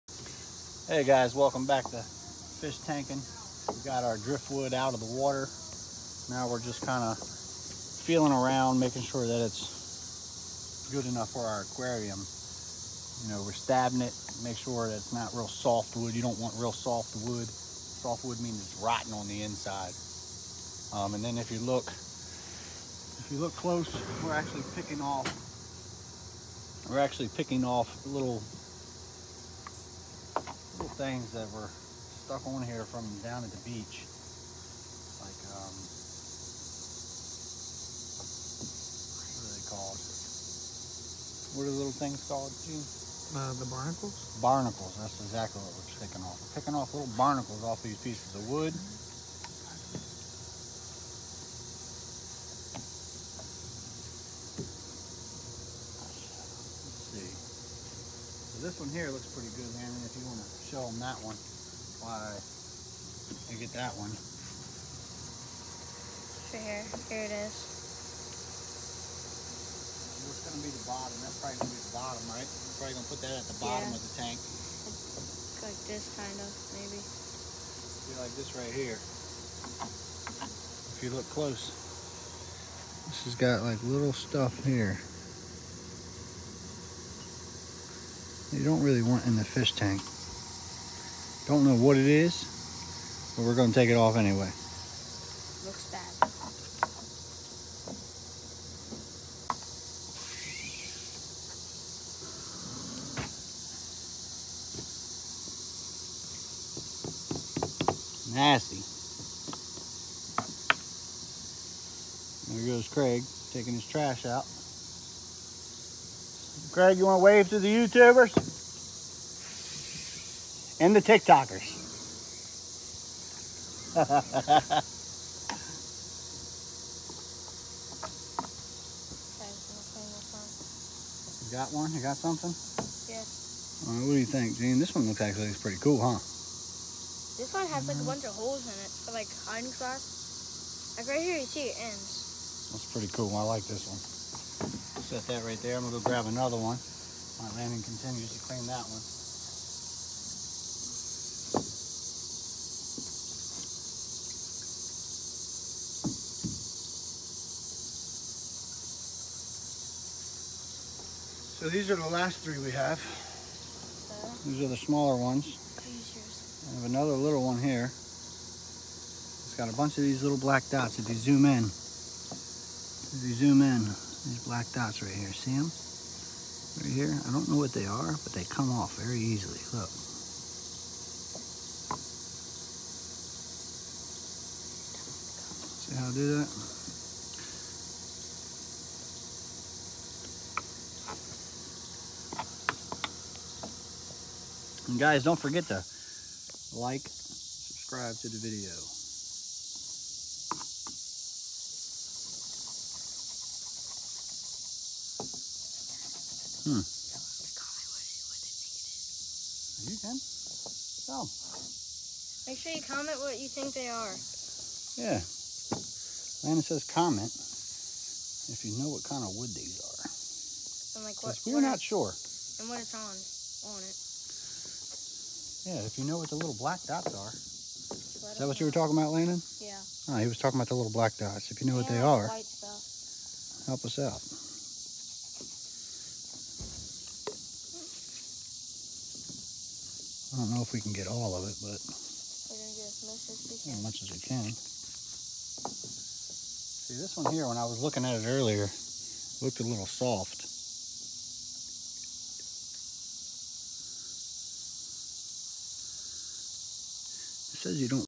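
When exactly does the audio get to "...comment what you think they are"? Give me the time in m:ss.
3:32.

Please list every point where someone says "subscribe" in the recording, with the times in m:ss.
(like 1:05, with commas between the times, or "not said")
3:17.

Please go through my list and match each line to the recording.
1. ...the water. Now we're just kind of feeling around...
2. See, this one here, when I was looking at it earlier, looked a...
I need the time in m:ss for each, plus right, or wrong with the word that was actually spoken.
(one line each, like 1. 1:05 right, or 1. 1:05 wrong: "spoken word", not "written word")
1. 0:04 right
2. 4:06 right.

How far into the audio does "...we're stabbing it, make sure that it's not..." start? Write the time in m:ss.
0:13.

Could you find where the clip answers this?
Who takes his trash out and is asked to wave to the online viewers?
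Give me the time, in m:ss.
1:56.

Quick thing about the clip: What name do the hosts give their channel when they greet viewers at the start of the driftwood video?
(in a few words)
Fishtankin.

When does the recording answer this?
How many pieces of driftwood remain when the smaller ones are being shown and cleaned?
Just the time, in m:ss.
2:42.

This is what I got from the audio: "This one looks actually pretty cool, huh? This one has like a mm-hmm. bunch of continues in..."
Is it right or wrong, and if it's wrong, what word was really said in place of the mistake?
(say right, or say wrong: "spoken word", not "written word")
wrong: "holes", not "continues".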